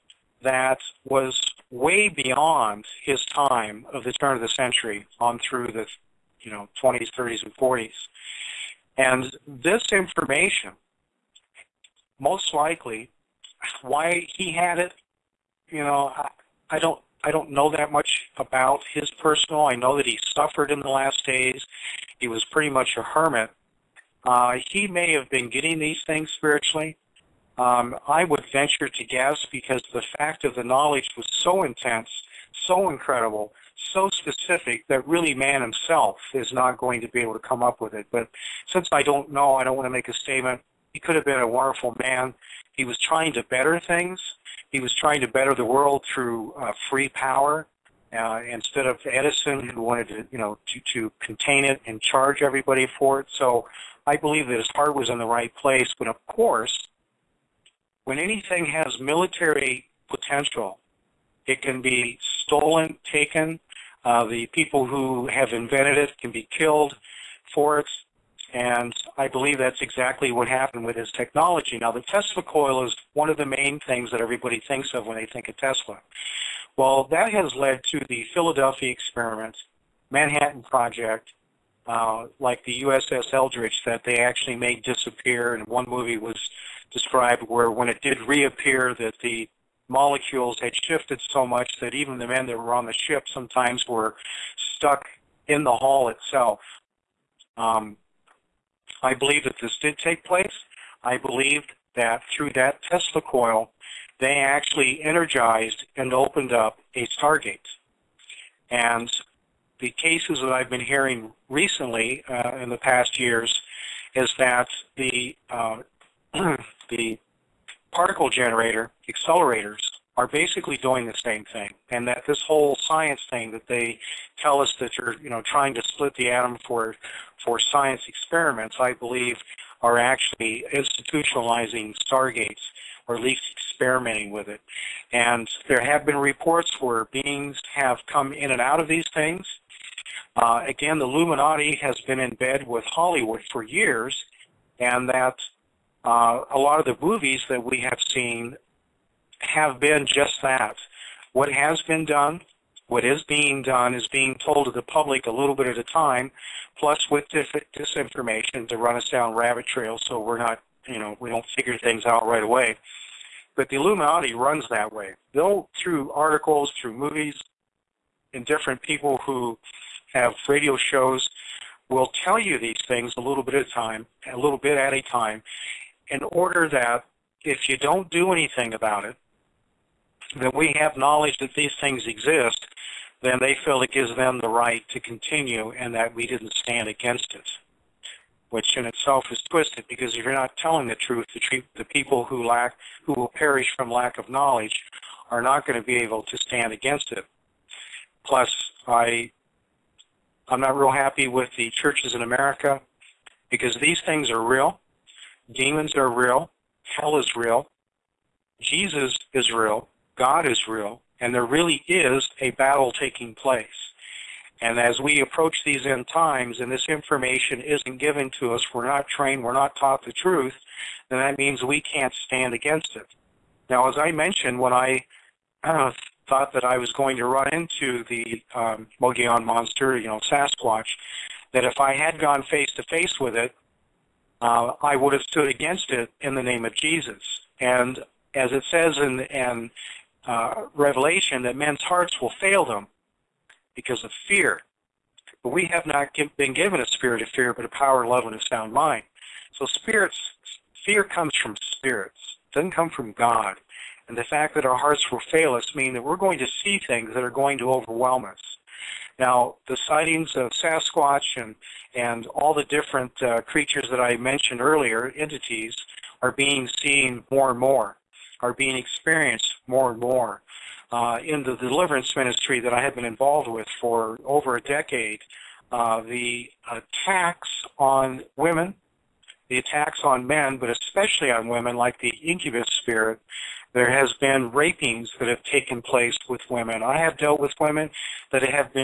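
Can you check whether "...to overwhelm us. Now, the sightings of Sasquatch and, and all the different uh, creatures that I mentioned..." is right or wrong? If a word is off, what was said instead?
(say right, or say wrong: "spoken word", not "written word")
right.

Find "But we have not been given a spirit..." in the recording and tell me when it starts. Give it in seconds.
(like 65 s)
245 s.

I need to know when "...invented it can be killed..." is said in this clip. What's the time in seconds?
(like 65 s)
65 s.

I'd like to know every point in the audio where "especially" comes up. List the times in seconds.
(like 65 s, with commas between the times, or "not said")
280 s.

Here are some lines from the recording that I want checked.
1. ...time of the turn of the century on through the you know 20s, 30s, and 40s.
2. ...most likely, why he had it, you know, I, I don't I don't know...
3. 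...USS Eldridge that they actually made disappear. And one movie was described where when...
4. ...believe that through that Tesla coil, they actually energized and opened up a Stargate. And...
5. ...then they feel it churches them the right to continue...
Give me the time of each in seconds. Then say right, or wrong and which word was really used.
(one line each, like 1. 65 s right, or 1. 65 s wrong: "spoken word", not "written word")
1. 3 s right
2. 12 s right
3. 82 s right
4. 101 s right
5. 183 s wrong: "gives", not "churches".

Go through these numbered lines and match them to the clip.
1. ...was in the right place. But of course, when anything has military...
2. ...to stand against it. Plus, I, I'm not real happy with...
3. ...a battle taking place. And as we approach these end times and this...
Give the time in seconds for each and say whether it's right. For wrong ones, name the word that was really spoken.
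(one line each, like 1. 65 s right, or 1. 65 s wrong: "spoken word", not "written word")
1. 54 s right
2. 196 s right
3. 212 s right.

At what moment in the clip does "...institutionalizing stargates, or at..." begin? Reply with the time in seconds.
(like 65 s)
130 s.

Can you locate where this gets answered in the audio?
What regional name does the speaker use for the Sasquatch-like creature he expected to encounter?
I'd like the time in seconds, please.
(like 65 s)
228 s.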